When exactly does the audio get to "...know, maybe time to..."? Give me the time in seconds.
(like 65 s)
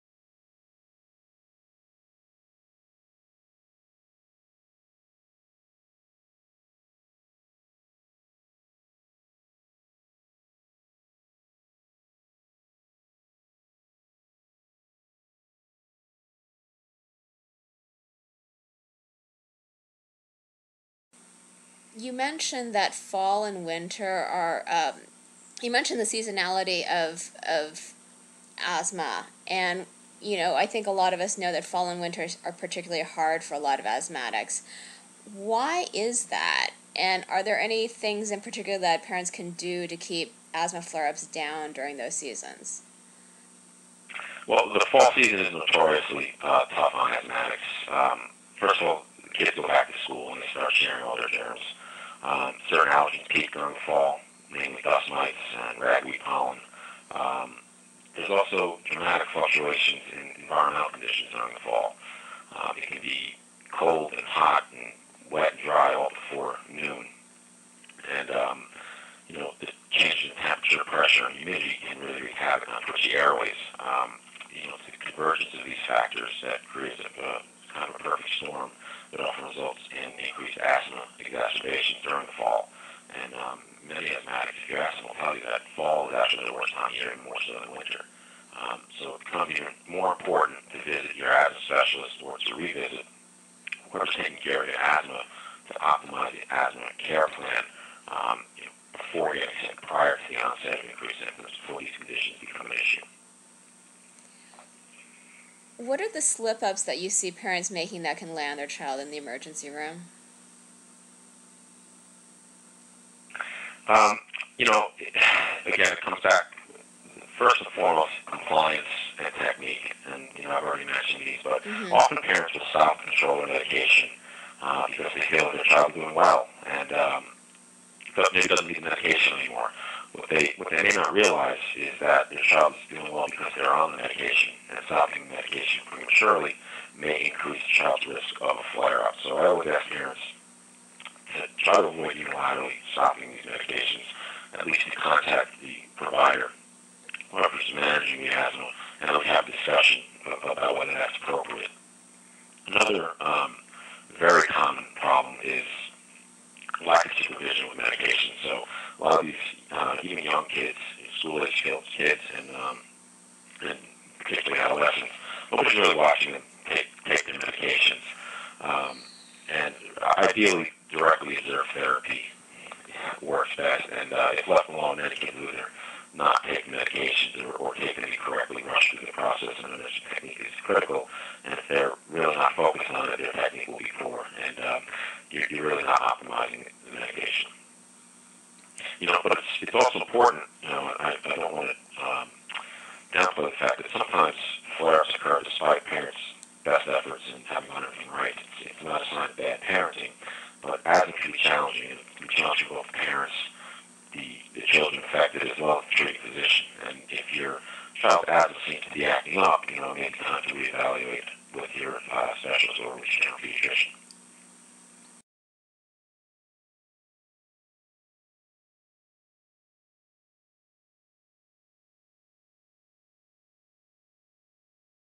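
209 s.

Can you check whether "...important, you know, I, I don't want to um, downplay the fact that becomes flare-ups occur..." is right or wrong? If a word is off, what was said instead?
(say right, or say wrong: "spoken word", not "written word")
wrong: "sometimes", not "becomes".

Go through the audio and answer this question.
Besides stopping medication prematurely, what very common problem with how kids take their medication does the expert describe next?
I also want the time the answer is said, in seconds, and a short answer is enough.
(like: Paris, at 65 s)
lack of supervision, at 156 s.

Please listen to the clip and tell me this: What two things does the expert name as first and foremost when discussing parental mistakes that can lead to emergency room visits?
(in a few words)
compliance and technique.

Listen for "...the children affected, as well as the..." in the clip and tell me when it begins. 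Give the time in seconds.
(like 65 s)
204 s.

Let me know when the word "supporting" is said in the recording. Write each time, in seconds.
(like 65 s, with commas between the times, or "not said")
not said.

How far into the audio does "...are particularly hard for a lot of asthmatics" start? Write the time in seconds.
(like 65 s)
32 s.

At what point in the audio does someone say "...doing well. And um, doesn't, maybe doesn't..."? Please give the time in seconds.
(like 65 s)
125 s.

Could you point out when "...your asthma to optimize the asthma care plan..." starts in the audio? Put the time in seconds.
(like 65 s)
94 s.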